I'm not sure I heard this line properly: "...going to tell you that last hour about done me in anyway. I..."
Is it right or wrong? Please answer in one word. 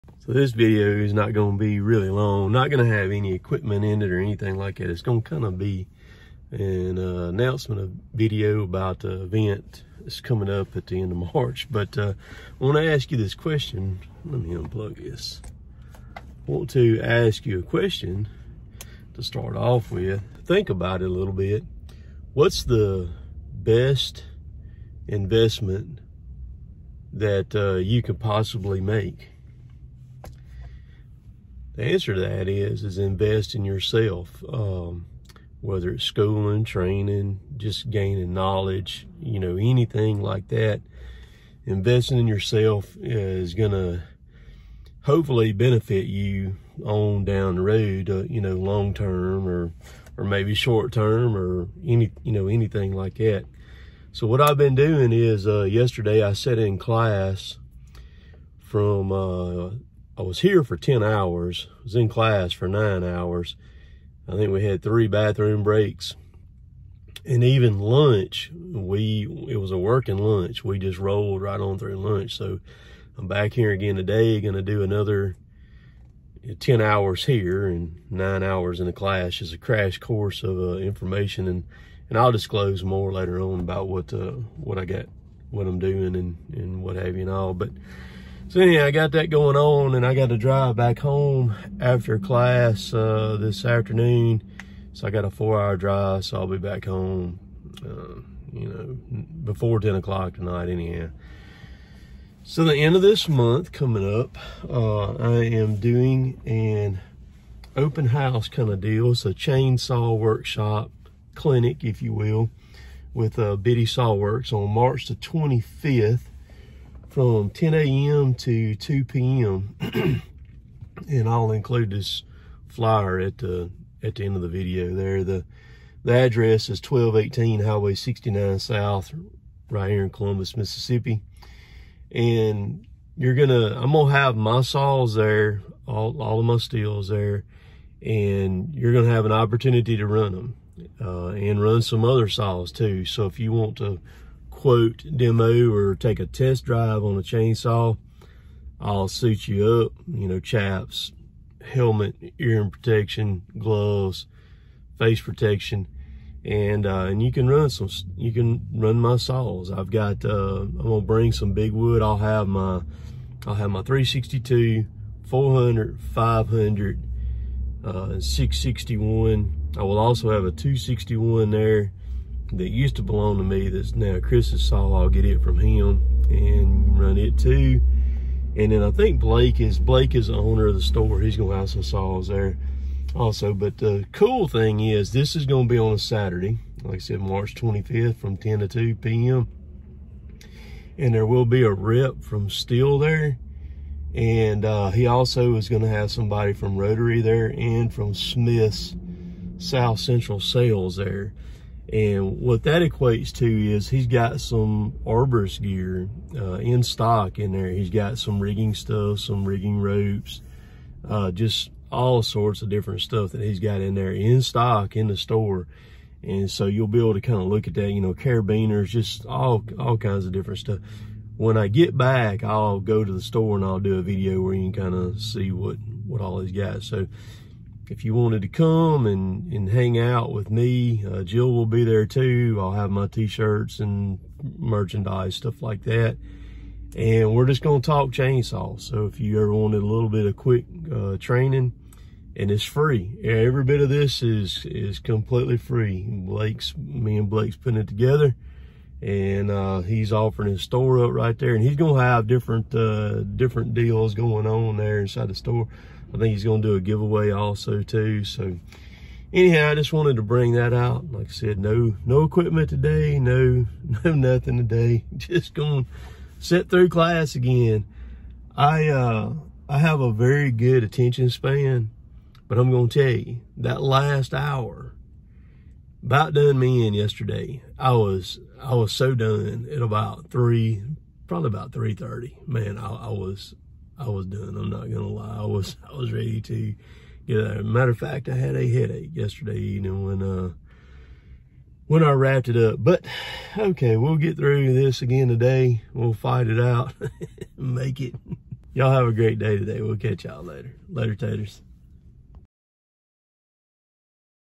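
wrong.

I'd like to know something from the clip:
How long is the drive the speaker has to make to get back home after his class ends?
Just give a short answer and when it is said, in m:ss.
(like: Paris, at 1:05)
4 hours, at 1:35.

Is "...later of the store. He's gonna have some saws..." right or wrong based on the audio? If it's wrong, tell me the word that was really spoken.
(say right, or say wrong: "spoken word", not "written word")
wrong: "owner", not "later".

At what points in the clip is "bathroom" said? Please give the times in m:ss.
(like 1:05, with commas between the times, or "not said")
1:05.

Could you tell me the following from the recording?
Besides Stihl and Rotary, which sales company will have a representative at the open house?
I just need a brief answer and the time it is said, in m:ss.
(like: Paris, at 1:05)
Smith's South Central Sales, at 3:18.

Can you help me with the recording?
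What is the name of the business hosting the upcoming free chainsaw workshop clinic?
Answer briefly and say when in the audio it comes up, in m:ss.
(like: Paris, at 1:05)
Biddy Saw Works, at 1:53.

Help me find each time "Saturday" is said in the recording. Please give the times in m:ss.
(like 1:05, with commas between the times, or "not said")
3:05.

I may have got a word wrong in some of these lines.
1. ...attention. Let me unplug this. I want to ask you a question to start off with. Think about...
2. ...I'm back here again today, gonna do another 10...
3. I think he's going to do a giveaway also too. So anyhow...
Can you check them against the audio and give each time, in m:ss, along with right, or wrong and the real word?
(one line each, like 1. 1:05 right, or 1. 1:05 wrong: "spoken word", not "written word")
1. 0:13 wrong: "question", not "attention"
2. 1:13 right
3. 4:16 right.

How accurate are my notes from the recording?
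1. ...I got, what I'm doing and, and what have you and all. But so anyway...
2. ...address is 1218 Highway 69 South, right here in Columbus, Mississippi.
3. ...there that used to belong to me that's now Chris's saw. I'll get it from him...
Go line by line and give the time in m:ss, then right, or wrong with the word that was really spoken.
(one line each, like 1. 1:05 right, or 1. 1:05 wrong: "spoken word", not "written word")
1. 1:24 right
2. 2:06 right
3. 2:51 right.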